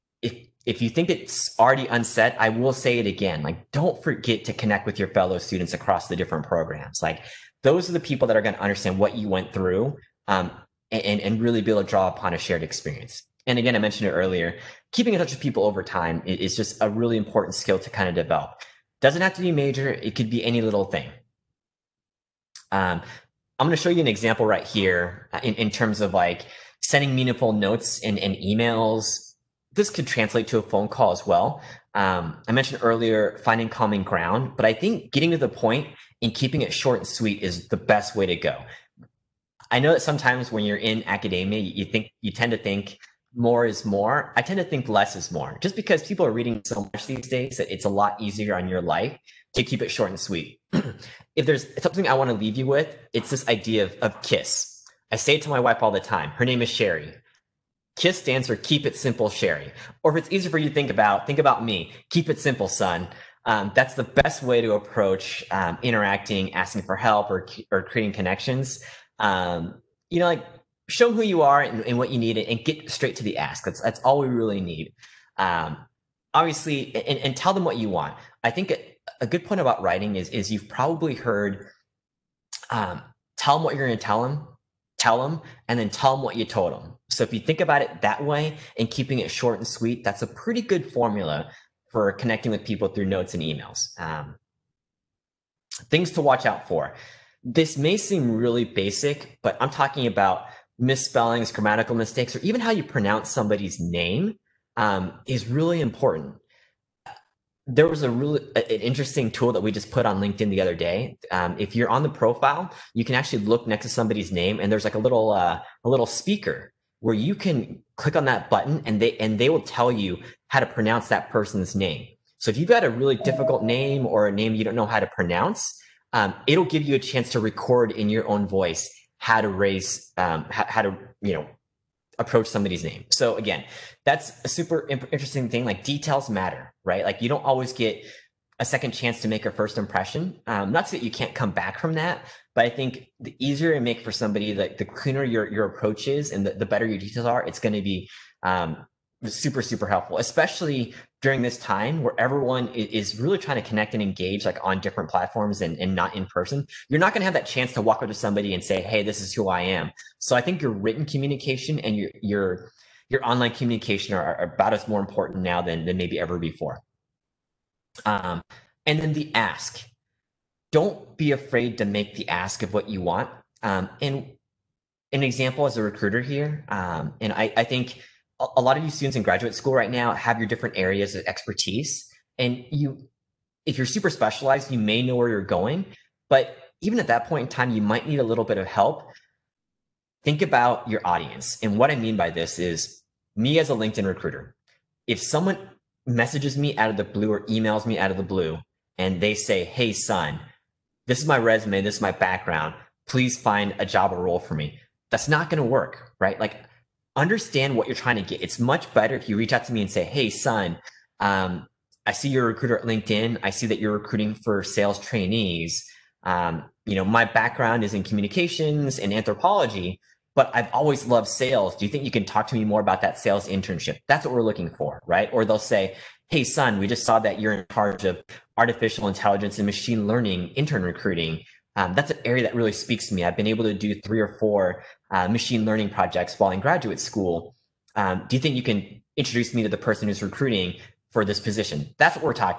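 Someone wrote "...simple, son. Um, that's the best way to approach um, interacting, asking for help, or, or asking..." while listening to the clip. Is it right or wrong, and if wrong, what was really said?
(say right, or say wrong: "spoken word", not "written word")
wrong: "creating", not "asking".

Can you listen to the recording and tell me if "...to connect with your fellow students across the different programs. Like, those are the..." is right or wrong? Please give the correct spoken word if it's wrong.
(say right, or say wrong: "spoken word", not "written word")
right.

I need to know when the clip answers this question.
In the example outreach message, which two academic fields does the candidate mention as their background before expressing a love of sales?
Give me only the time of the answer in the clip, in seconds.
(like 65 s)
218 s.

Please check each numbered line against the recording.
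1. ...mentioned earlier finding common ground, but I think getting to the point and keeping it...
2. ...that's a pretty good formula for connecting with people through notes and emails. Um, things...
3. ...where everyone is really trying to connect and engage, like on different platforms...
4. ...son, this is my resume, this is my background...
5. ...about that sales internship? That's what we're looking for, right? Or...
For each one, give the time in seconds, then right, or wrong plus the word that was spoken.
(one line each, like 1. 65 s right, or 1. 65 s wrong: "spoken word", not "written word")
1. 32 s right
2. 90 s right
3. 152 s right
4. 199 s right
5. 222 s right.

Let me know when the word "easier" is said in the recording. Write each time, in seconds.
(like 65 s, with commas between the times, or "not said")
48 s, 60 s, 143 s.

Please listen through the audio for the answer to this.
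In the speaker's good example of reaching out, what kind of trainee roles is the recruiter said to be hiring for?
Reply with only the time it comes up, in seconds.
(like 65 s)
214 s.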